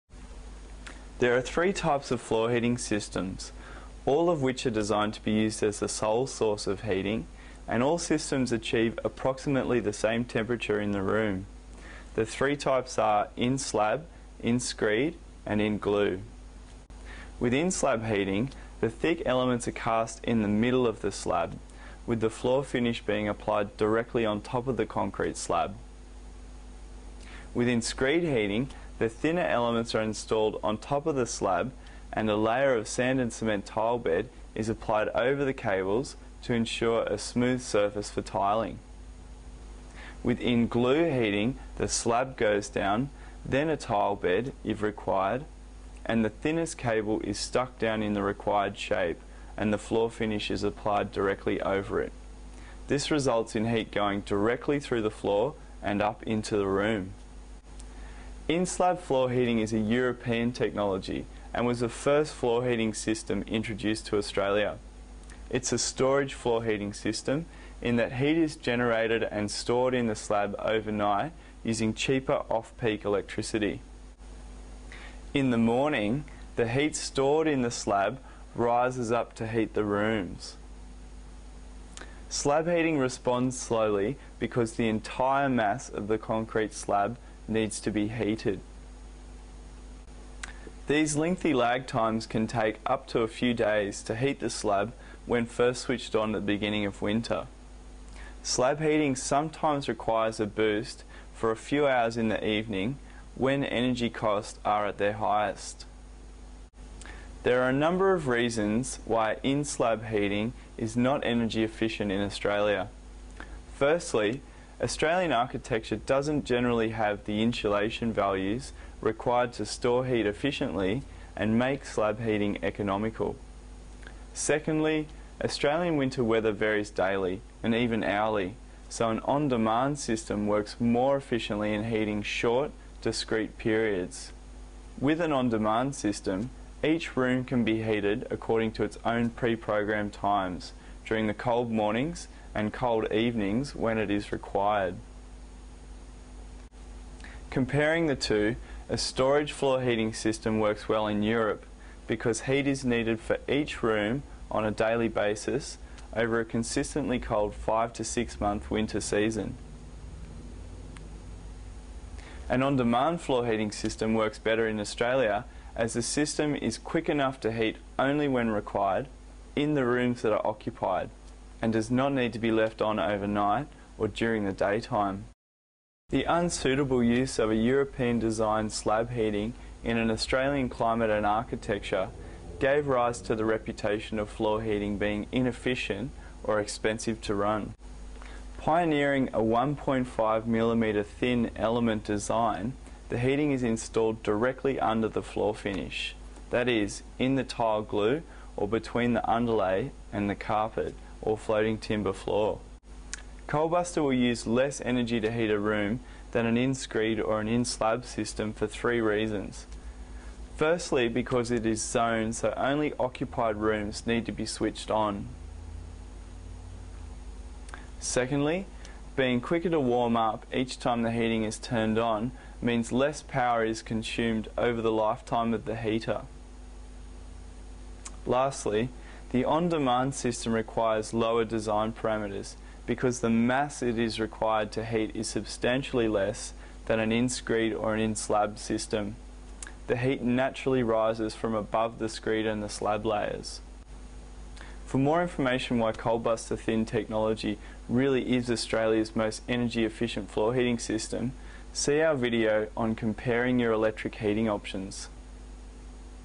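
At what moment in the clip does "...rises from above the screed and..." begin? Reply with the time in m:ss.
4:00.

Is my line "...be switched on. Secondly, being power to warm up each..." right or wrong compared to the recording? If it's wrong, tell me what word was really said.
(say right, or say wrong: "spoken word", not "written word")
wrong: "quicker", not "power".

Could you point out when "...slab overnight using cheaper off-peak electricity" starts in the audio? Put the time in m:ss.
1:10.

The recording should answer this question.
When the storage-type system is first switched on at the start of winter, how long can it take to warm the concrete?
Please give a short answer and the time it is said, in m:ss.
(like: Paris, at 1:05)
up to a few days, at 1:32.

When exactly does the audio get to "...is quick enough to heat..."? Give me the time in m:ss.
2:46.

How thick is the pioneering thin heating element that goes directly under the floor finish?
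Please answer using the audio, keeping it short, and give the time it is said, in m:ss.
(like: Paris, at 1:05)
1.5 millimeters, at 3:09.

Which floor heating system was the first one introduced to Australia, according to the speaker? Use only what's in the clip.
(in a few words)
In-slab floor heating.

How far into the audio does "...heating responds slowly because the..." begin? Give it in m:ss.
1:22.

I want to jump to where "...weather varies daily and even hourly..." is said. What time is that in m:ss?
2:06.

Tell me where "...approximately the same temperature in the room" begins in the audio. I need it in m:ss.
0:09.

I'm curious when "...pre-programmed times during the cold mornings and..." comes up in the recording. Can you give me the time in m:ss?
2:19.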